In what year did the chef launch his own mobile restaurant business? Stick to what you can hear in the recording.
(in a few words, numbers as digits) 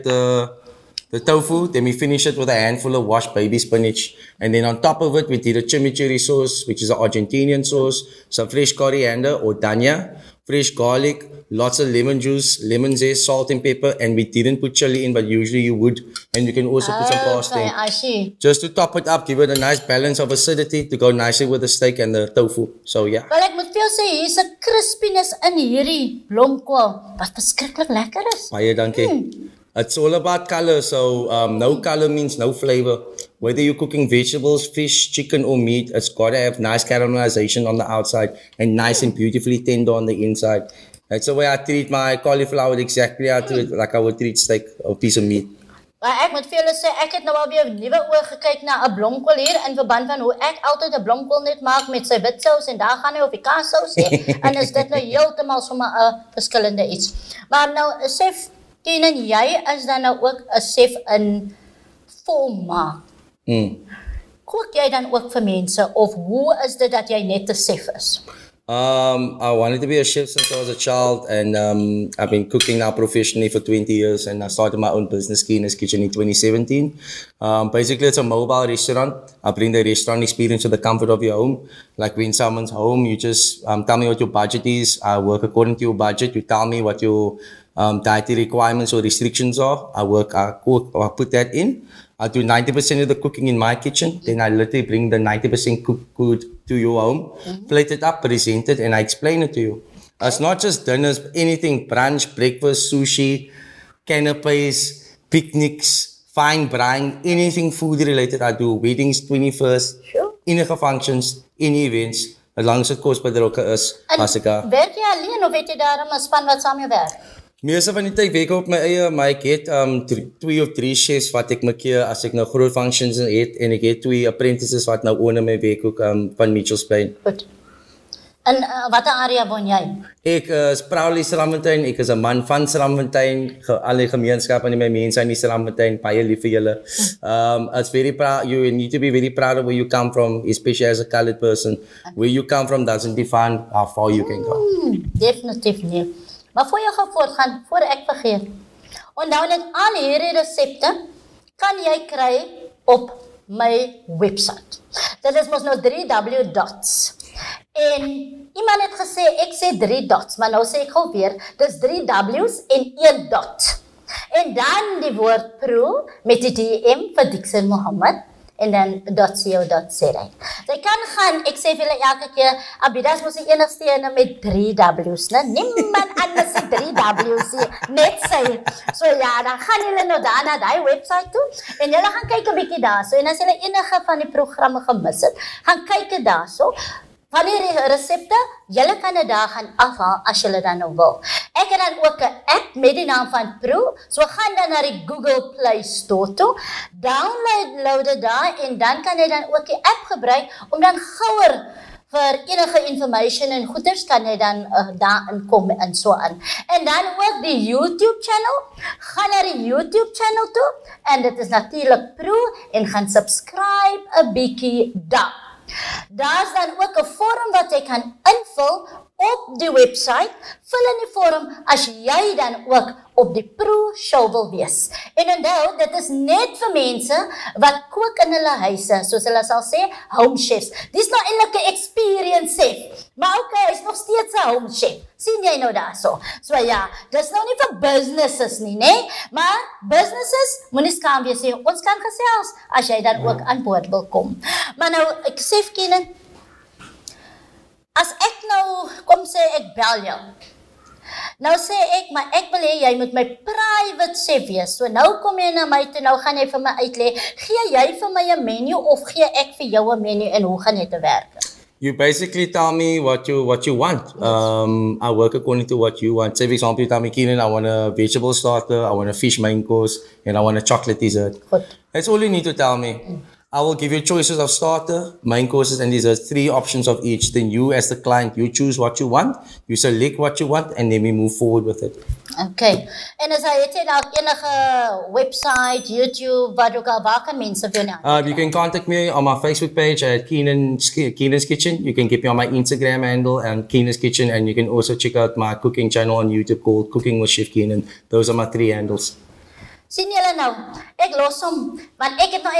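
2017.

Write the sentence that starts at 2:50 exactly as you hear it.
Jy kan gaan, ek sê vir julle elke keer, Abidas moet se enigste een met 3 W's, né?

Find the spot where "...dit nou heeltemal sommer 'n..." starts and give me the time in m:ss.
0:54.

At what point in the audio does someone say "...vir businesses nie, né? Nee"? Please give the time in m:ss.
3:57.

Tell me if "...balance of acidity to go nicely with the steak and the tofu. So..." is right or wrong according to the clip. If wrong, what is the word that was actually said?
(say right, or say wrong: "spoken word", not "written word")
right.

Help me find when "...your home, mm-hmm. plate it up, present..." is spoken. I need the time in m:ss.
1:36.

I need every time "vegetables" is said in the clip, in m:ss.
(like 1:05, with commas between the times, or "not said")
0:34, 4:28.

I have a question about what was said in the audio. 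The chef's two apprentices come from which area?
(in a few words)
Mitchells Bay.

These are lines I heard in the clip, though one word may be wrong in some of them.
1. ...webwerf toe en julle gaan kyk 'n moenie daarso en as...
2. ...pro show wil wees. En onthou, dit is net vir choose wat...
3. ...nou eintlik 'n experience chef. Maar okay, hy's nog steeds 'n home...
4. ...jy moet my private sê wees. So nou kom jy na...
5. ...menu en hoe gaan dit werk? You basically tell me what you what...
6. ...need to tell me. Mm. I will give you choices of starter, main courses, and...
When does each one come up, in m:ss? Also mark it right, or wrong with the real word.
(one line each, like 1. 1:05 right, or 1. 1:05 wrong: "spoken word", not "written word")
1. 3:00 wrong: "bietjie", not "moenie"
2. 3:43 wrong: "mense", not "choose"
3. 3:51 right
4. 4:12 right
5. 4:20 right
6. 4:32 right.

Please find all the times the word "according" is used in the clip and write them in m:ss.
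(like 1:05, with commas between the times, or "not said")
1:25, 4:25.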